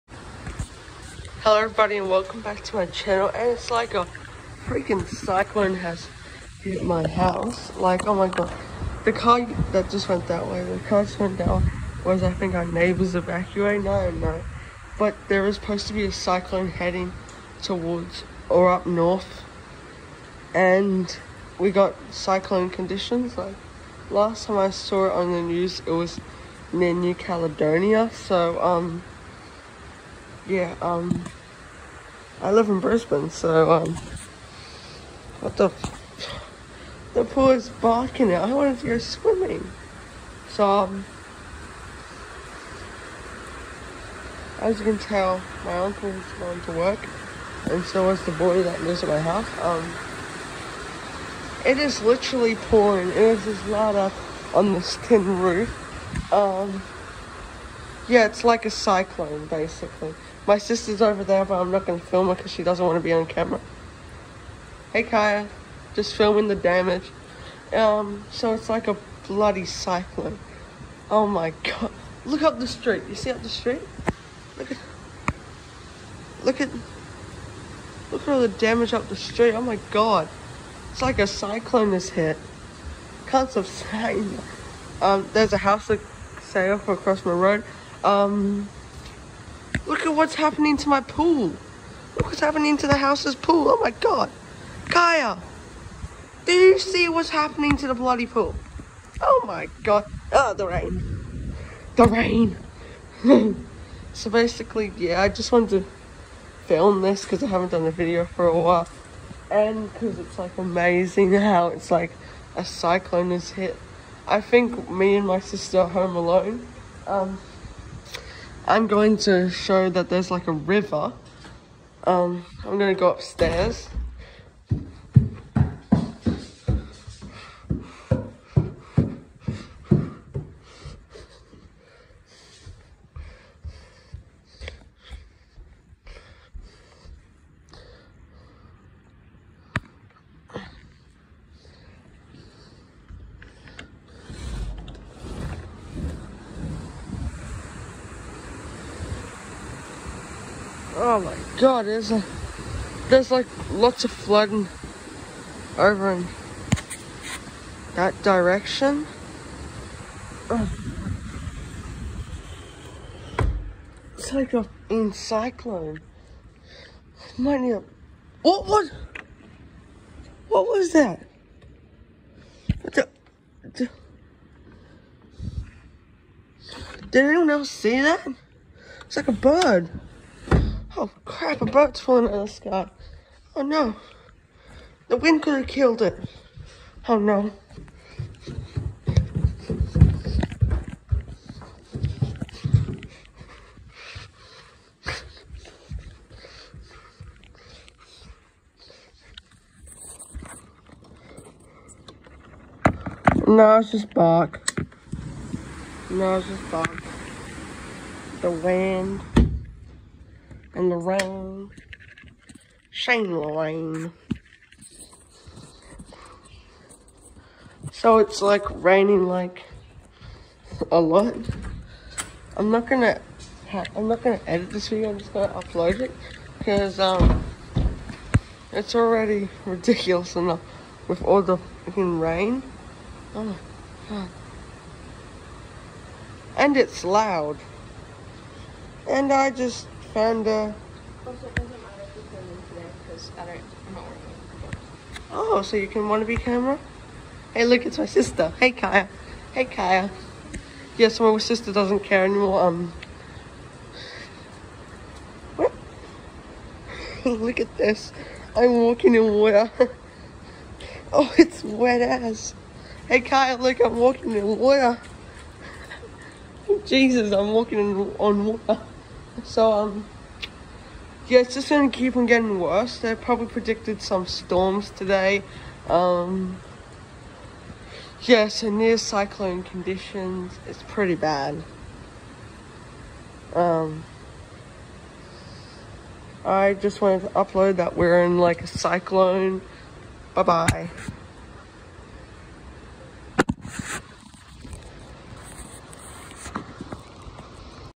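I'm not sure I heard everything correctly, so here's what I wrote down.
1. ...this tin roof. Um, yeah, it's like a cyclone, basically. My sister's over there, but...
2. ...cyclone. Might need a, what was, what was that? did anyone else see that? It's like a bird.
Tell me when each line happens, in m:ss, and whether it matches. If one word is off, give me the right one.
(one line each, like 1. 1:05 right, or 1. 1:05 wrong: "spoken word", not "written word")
1. 0:54 right
2. 2:45 right.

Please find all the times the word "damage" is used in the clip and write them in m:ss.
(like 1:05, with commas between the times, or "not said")
1:06, 1:18.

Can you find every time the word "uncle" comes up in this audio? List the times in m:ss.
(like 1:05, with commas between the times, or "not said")
0:45.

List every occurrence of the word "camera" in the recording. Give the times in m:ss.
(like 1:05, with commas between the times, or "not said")
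1:03, 4:06.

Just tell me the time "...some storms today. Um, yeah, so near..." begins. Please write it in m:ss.
4:34.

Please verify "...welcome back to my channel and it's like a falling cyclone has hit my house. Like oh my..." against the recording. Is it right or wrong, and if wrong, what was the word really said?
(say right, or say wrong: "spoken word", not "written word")
wrong: "freaking", not "falling".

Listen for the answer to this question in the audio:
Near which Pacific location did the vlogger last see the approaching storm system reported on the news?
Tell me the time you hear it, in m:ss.
0:26.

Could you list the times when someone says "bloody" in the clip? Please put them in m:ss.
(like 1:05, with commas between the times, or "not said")
1:09, 1:37.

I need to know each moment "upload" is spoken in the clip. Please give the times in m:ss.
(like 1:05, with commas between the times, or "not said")
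3:45, 4:47.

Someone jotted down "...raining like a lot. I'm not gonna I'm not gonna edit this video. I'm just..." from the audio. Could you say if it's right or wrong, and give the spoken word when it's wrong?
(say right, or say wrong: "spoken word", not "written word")
right.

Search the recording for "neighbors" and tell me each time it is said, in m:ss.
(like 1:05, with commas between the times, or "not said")
0:12.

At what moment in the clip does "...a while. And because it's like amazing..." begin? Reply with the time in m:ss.
1:48.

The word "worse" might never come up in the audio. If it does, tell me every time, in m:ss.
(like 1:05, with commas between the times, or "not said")
4:32.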